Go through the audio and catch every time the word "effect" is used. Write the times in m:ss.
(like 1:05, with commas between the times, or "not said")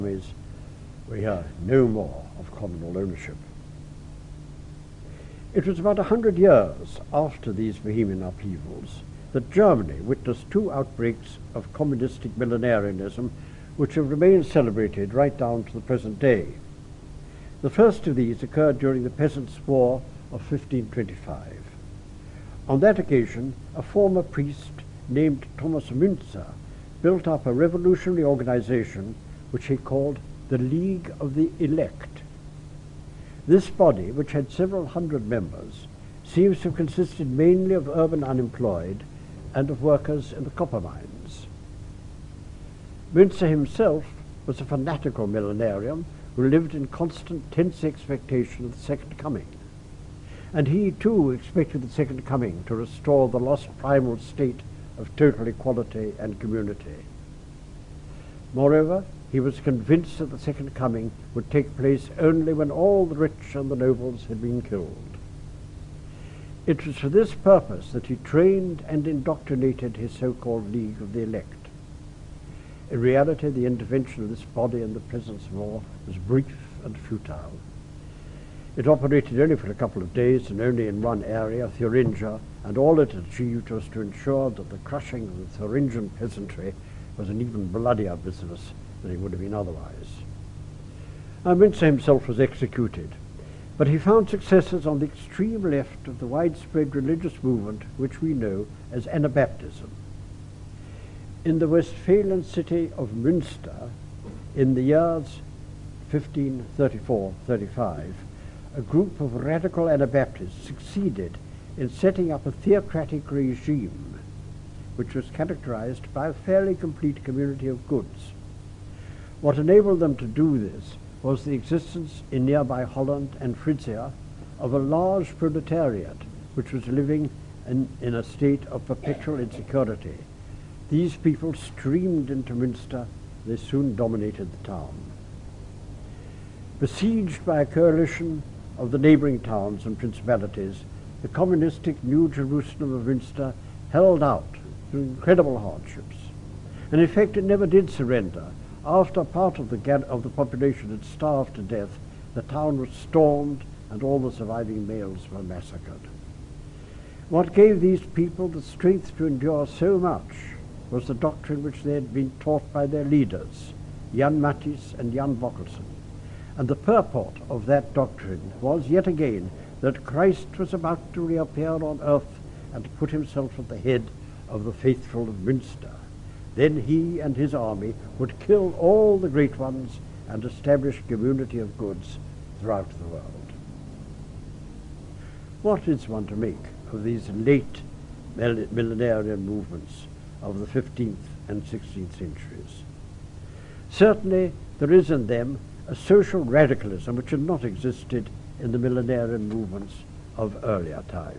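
2:27.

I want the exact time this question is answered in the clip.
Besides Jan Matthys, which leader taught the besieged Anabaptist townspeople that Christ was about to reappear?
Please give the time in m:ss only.
2:45.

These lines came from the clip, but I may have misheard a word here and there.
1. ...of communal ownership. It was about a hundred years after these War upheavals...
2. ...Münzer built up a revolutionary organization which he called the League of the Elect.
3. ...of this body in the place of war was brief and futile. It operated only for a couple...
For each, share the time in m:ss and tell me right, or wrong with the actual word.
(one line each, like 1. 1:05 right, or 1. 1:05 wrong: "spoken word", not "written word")
1. 0:02 wrong: "Bohemian", not "War"
2. 0:25 right
3. 1:14 wrong: "presence", not "place".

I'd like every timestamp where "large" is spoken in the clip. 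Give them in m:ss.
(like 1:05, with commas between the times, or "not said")
2:04.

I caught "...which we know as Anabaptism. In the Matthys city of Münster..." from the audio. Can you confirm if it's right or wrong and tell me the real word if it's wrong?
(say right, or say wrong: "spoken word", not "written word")
wrong: "Westphalian", not "Matthys".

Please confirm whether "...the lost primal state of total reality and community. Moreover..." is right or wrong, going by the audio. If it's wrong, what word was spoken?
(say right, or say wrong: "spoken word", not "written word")
wrong: "equality", not "reality".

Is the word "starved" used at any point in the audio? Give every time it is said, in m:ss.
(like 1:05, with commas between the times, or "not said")
2:31.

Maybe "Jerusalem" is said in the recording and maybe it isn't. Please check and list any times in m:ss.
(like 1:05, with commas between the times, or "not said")
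2:22.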